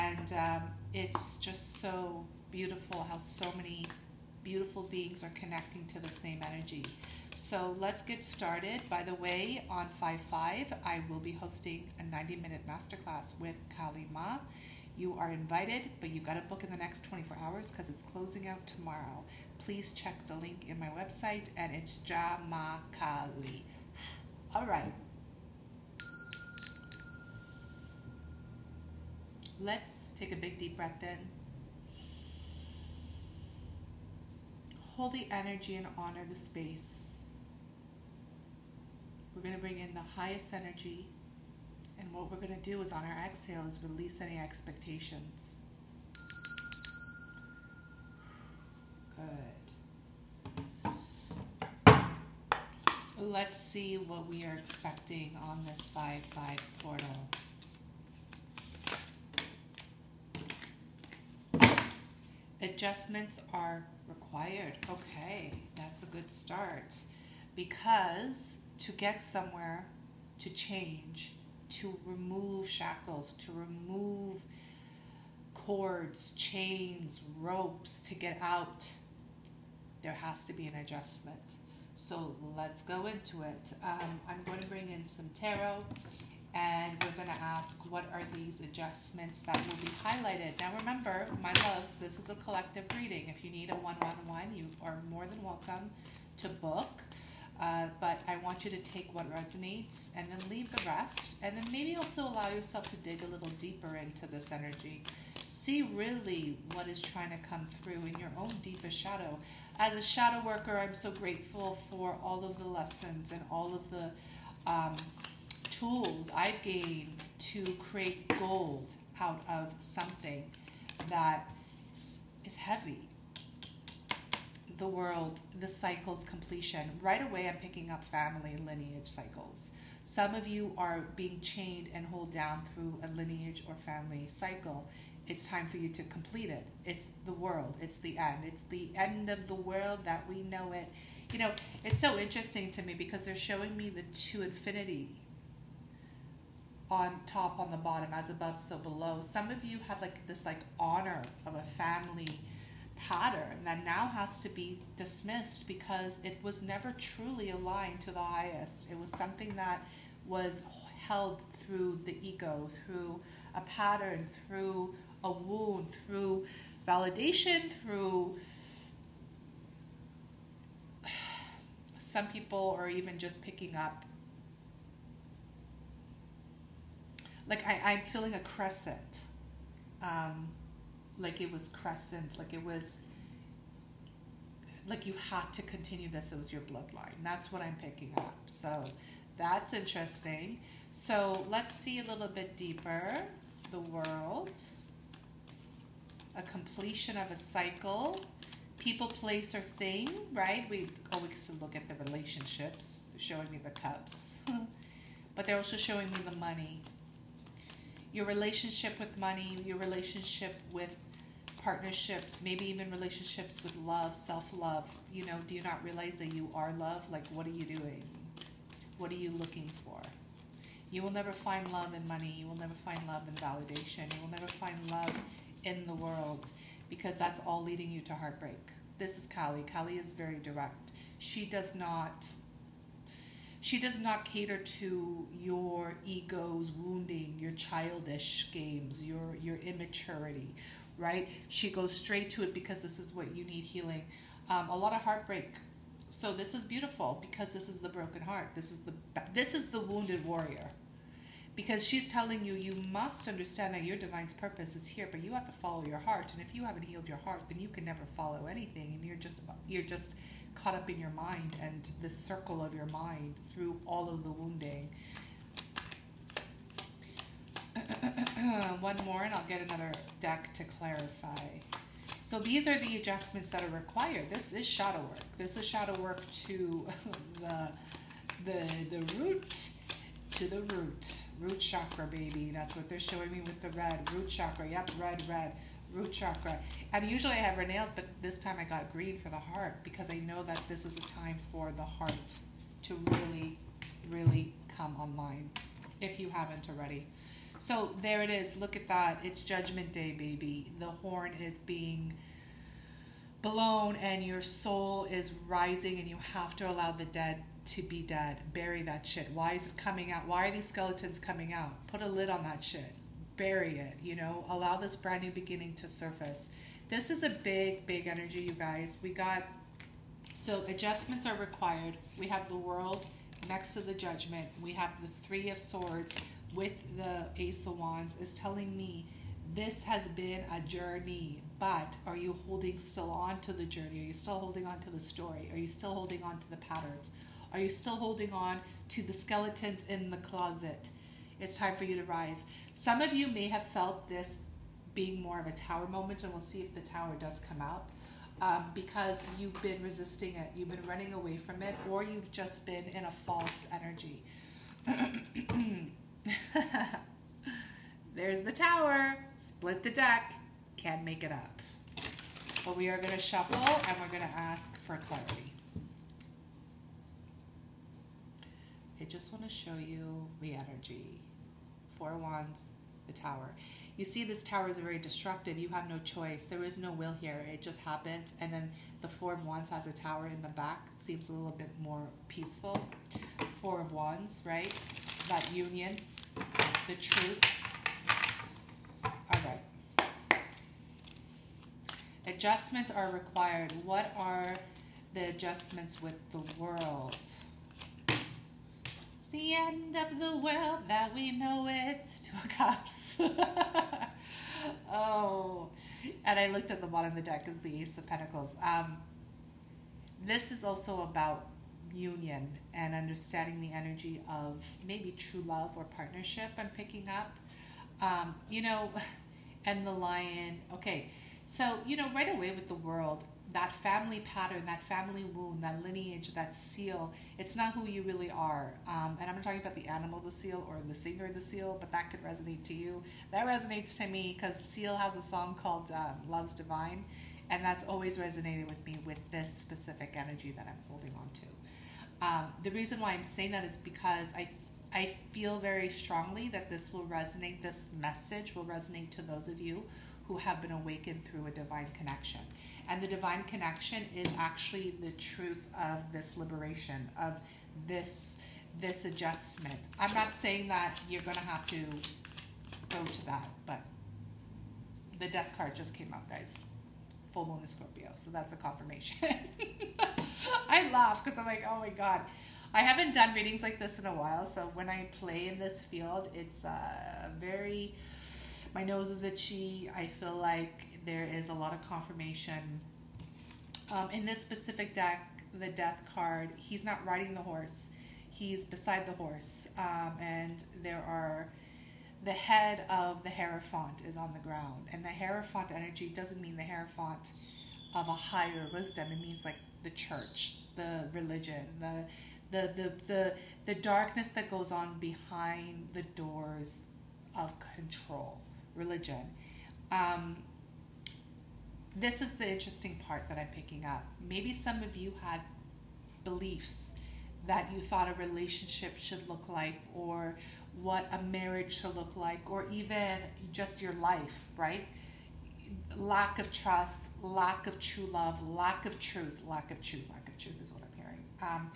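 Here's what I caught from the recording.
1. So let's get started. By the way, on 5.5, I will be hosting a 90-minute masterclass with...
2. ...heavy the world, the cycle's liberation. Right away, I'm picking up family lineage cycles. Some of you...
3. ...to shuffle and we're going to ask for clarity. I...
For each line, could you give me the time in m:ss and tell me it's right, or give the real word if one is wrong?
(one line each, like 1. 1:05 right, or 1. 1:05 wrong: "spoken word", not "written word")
1. 0:07 right
2. 2:02 wrong: "completion", not "liberation"
3. 6:03 right.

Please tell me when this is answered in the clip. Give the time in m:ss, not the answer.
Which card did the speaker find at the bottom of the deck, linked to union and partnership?
6:47.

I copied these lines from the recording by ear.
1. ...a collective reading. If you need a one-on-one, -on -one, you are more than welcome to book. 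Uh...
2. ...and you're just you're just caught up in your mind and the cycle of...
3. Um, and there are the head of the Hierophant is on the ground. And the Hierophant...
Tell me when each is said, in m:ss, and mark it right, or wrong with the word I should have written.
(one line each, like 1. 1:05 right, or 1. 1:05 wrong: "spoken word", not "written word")
1. 1:32 right
2. 4:18 wrong: "circle", not "cycle"
3. 8:09 right.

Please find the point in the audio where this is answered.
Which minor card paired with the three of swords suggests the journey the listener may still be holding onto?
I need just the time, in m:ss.
5:27.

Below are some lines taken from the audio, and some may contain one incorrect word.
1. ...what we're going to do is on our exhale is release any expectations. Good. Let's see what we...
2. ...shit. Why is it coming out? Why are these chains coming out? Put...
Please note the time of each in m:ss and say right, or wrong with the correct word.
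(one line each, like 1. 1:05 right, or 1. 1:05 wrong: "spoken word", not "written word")
1. 0:42 right
2. 5:09 wrong: "skeletons", not "chains".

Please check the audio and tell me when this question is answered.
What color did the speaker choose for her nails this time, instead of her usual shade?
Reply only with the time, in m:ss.
4:48.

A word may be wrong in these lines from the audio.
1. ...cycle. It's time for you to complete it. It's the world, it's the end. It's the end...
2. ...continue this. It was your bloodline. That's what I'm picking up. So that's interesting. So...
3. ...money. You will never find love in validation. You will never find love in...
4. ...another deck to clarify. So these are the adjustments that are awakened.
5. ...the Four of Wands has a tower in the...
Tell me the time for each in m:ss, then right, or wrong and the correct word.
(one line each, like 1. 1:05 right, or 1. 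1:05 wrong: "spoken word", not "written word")
1. 2:14 right
2. 3:05 right
3. 3:42 right
4. 4:29 wrong: "required", not "awakened"
5. 6:19 right.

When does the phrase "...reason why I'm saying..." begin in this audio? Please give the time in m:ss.
7:22.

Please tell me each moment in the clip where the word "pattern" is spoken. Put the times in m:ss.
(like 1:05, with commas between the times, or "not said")
2:32, 2:43, 5:36, 7:04.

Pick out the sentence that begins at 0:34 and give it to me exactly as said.
Hold the energy and honor the space.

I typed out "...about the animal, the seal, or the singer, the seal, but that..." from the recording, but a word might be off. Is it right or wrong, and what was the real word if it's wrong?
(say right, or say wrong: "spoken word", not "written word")
right.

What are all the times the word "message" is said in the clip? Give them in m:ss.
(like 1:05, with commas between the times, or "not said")
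7:27.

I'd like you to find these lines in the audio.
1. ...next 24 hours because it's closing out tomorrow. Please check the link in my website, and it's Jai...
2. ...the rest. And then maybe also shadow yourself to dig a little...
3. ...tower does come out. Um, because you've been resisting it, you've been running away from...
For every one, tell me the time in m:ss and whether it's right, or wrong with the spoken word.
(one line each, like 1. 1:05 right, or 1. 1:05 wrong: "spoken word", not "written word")
1. 0:16 right
2. 1:40 wrong: "allow", not "shadow"
3. 5:46 right.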